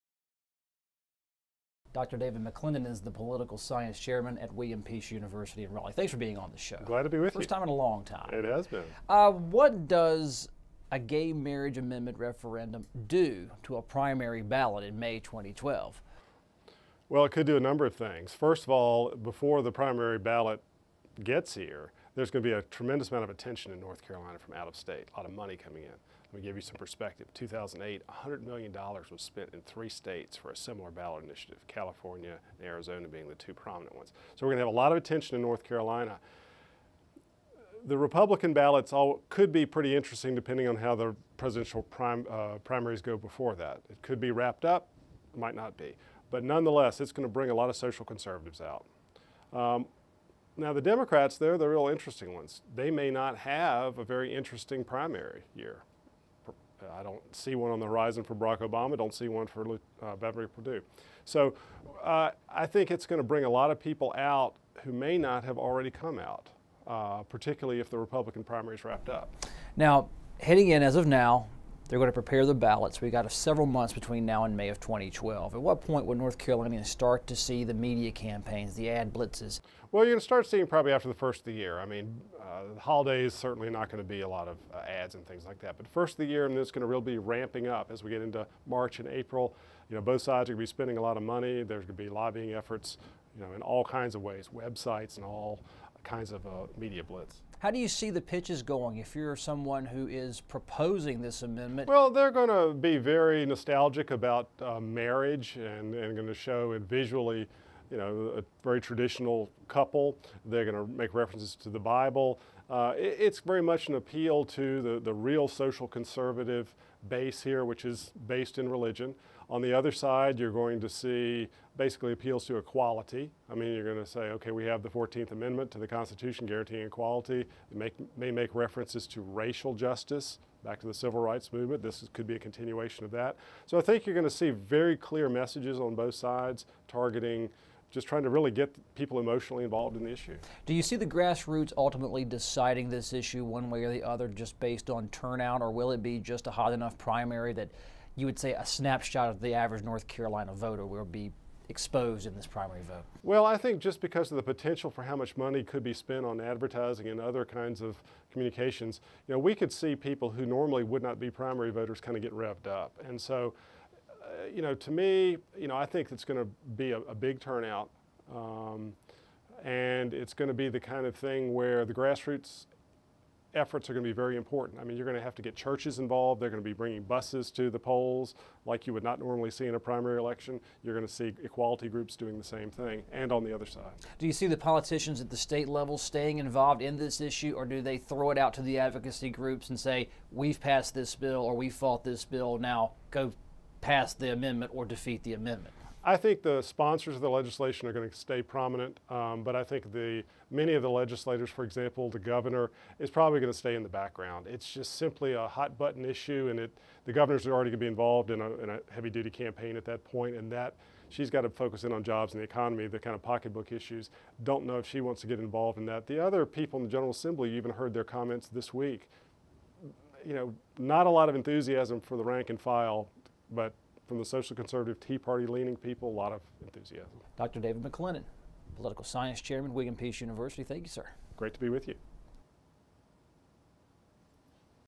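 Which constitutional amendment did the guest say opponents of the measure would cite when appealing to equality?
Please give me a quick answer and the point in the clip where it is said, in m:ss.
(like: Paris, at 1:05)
14th Amendment, at 2:04.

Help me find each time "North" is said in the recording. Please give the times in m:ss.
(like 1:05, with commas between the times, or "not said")
0:23, 0:35, 1:16, 2:29.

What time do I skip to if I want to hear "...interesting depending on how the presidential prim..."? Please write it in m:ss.
0:39.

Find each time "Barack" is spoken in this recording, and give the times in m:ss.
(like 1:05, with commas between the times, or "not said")
0:58.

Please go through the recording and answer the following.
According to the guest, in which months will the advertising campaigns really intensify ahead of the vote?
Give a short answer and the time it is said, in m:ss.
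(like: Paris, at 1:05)
March and April, at 1:28.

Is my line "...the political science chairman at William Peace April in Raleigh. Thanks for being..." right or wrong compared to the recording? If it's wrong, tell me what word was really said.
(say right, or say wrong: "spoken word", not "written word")
wrong: "University", not "April".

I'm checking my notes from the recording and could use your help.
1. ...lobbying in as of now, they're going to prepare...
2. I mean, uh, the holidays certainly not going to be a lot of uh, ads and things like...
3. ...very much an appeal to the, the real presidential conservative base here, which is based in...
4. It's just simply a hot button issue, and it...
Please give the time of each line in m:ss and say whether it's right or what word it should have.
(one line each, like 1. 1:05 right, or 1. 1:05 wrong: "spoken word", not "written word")
1. 1:10 wrong: "heading", not "lobbying"
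2. 1:21 right
3. 1:53 wrong: "social", not "presidential"
4. 3:24 right.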